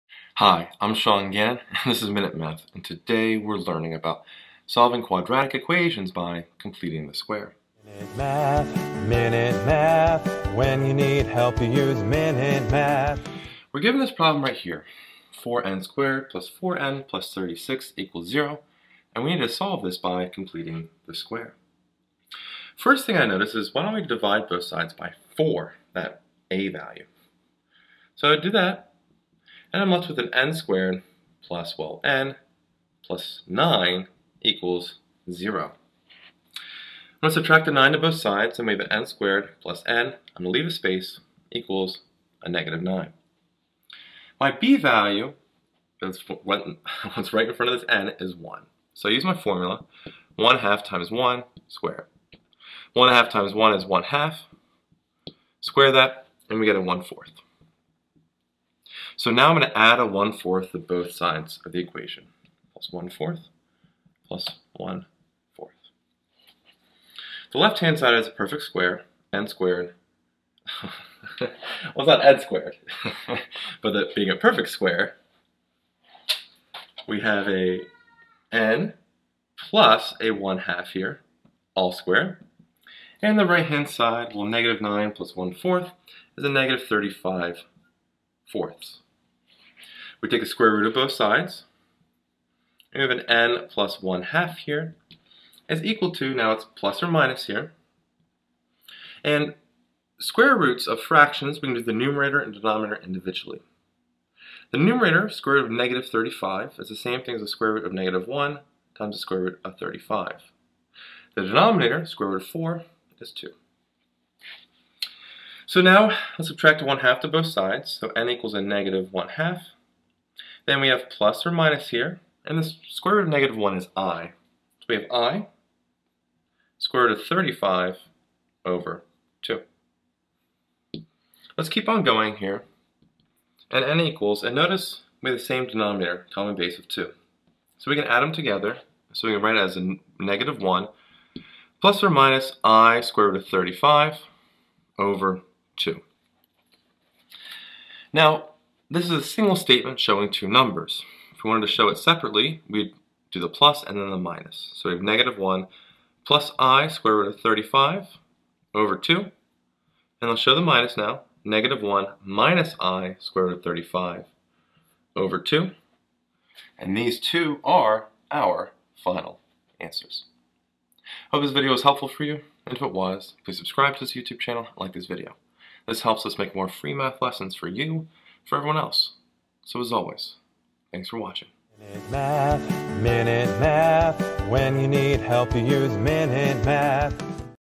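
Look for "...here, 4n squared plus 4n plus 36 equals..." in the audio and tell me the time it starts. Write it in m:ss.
0:14.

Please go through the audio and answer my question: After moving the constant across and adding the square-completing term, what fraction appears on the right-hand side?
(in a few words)
-35/4.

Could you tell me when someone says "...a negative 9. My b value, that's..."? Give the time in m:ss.
0:42.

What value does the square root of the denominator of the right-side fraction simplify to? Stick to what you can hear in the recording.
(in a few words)
2.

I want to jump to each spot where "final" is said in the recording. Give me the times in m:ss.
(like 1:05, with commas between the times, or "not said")
2:49.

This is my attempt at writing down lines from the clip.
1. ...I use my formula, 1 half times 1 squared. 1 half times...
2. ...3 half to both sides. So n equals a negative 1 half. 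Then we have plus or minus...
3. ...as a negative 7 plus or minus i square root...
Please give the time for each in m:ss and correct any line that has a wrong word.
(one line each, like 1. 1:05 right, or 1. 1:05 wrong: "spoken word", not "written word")
1. 0:49 right
2. 1:56 wrong: "1", not "3"
3. 2:19 wrong: "1", not "7".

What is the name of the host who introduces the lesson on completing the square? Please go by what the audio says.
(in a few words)
Sean Gannon.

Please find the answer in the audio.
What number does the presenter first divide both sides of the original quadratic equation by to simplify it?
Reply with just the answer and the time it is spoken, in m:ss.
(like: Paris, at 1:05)
4, at 0:24.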